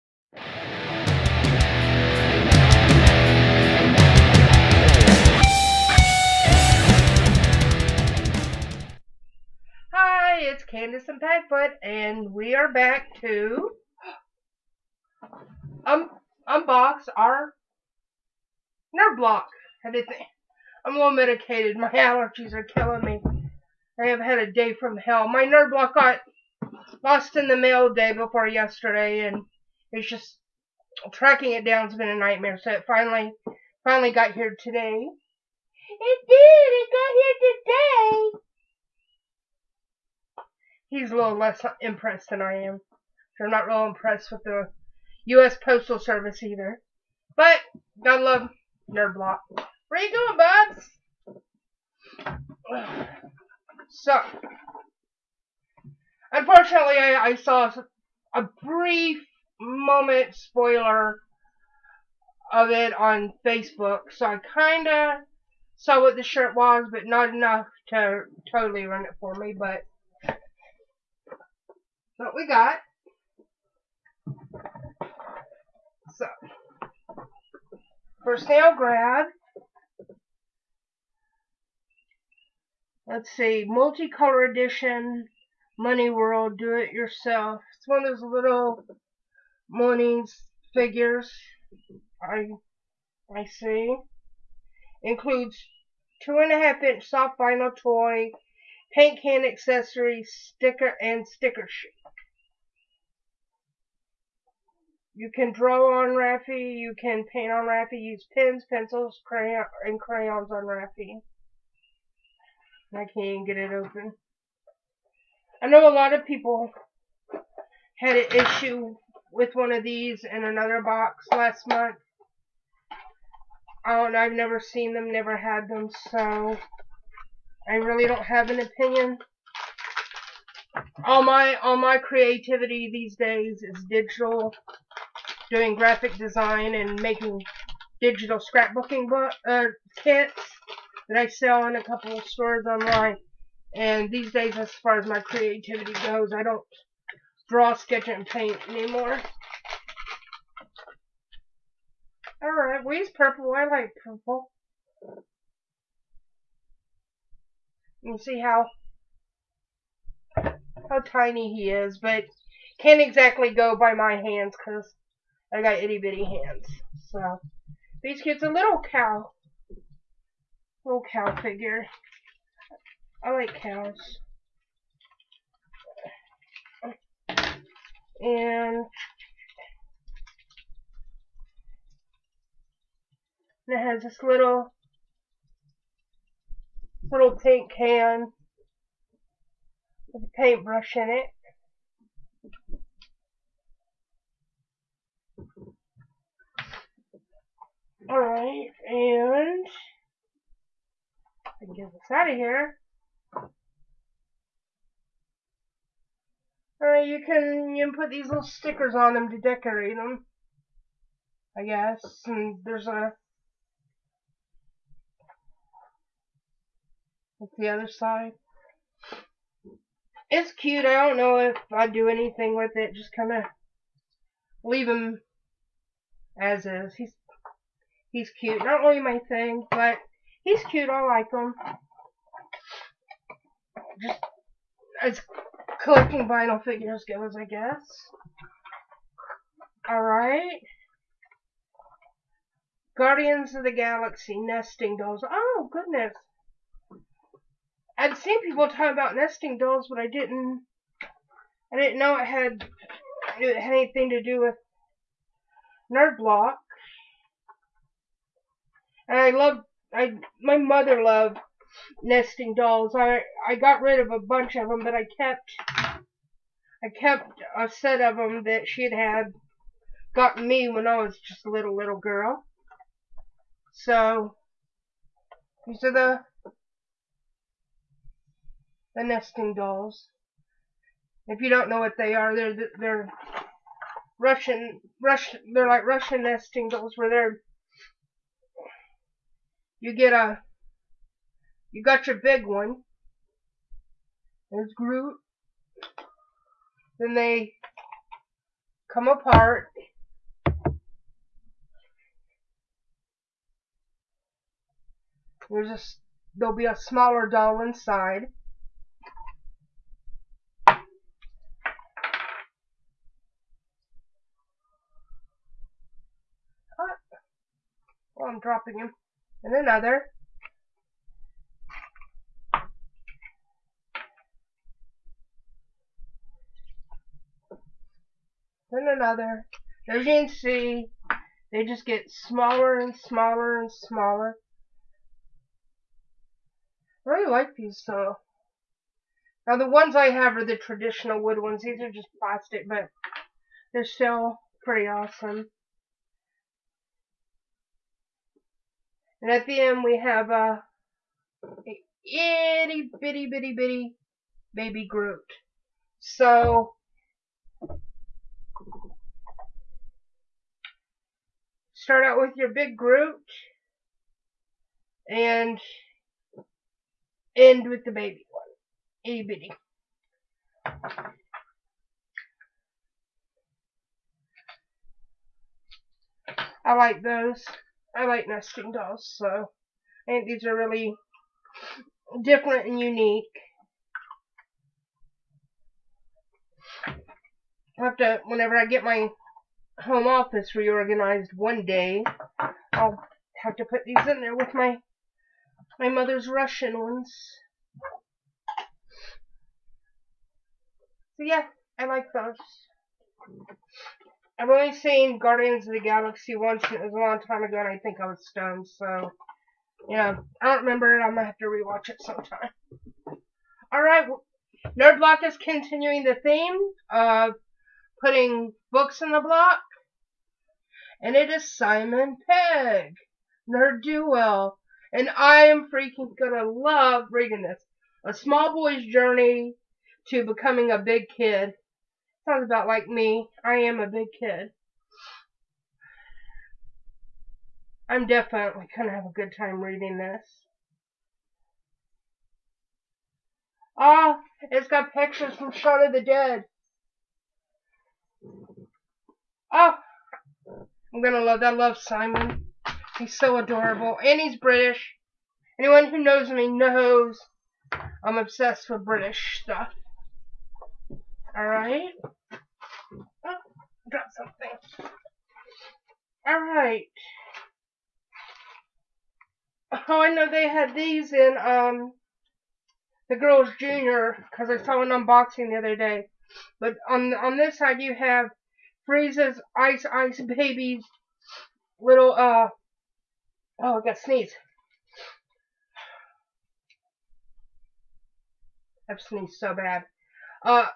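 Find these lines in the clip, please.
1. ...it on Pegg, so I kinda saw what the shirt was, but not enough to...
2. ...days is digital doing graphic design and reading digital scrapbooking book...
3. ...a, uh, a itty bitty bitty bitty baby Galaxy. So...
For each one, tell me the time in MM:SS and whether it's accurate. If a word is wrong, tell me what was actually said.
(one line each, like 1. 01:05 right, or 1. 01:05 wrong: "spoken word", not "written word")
1. 01:02 wrong: "Facebook", not "Pegg"
2. 02:13 wrong: "making", not "reading"
3. 05:50 wrong: "Groot", not "Galaxy".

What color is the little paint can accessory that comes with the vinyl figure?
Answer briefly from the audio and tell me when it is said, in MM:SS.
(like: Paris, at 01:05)
Pink, at 03:07.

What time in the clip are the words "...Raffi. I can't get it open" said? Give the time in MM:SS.
01:50.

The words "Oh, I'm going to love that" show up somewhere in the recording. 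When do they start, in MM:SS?
07:29.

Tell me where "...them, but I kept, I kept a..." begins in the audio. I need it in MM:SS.
04:24.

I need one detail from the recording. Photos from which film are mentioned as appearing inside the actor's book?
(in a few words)
Shaun of the Dead.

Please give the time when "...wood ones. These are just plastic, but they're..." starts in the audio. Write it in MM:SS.
05:41.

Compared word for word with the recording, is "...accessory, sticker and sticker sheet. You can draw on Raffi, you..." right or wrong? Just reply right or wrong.
right.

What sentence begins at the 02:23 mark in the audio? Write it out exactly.
And these days, as far as my creativity goes, I don't draw, sketch, and paint anymore.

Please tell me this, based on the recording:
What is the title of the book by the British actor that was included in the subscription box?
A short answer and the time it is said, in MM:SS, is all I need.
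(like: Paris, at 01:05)
Nerd Do Well, at 07:03.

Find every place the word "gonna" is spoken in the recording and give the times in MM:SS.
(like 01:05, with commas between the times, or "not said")
06:51, 07:06.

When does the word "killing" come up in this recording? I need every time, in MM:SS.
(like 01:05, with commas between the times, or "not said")
00:22.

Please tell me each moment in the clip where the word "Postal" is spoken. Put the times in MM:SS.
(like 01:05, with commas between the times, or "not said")
00:45.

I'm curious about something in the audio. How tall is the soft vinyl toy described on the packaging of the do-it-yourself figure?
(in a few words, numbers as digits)
2.5 inches.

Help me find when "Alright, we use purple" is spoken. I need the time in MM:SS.
02:32.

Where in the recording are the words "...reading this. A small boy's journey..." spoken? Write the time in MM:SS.
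07:07.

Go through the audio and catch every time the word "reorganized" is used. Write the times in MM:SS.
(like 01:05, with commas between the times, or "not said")
06:30.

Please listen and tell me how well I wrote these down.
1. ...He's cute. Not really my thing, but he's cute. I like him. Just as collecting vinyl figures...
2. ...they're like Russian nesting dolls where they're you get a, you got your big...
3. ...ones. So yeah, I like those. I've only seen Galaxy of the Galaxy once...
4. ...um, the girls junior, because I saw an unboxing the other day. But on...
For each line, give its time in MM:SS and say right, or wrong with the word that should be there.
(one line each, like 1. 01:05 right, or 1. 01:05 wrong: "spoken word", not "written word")
1. 03:48 right
2. 04:45 right
3. 06:36 wrong: "Guardians", not "Galaxy"
4. 07:51 right.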